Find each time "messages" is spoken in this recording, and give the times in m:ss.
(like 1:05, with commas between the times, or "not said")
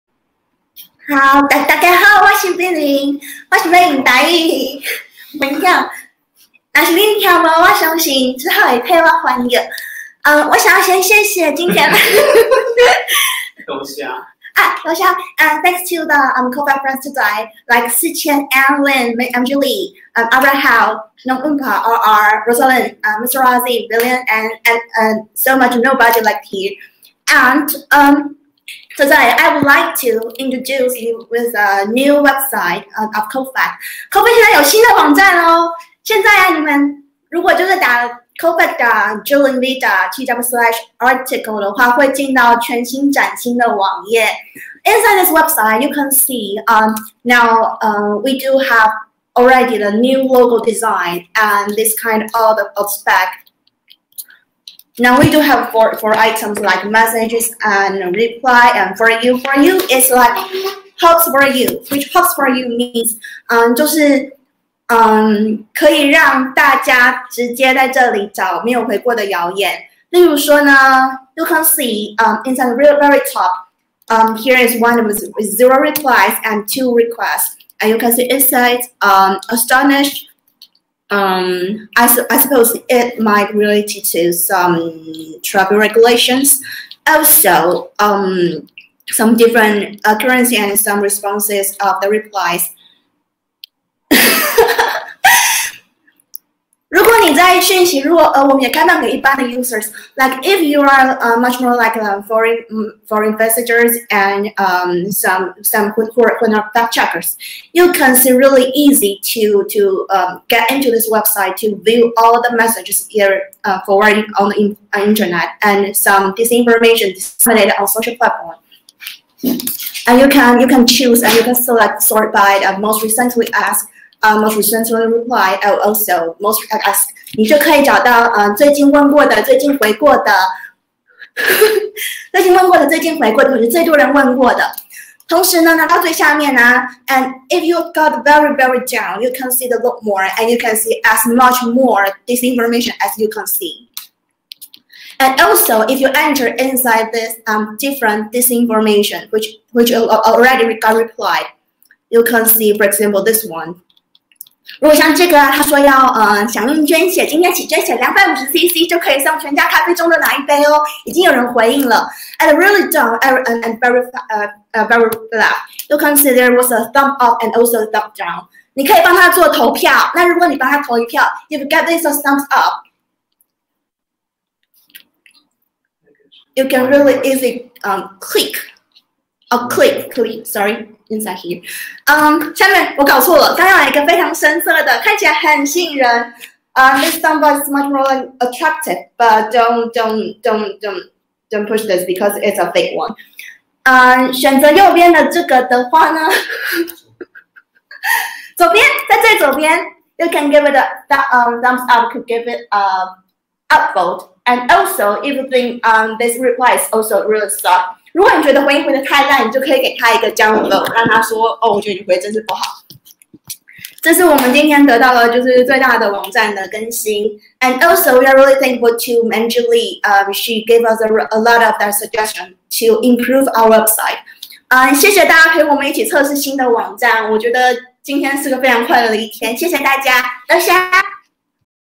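0:56, 1:52.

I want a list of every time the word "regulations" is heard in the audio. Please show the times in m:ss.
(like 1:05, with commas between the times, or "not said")
1:25.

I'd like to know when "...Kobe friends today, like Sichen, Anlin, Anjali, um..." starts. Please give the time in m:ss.
0:16.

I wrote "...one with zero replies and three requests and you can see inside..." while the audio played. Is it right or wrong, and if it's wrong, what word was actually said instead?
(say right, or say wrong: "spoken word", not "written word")
wrong: "two", not "three".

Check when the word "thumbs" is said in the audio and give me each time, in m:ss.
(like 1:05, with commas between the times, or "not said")
2:52, 3:21.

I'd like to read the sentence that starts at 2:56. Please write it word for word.
You can really easy um click.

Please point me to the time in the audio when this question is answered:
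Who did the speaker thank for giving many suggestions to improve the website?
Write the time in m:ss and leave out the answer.
3:39.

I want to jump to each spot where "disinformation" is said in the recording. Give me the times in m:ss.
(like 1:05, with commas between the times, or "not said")
1:56, 2:28.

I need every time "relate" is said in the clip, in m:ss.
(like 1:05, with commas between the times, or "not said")
1:23.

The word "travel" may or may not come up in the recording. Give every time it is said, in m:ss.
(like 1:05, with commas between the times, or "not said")
1:25.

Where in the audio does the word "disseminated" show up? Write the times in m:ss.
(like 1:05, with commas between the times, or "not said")
1:57.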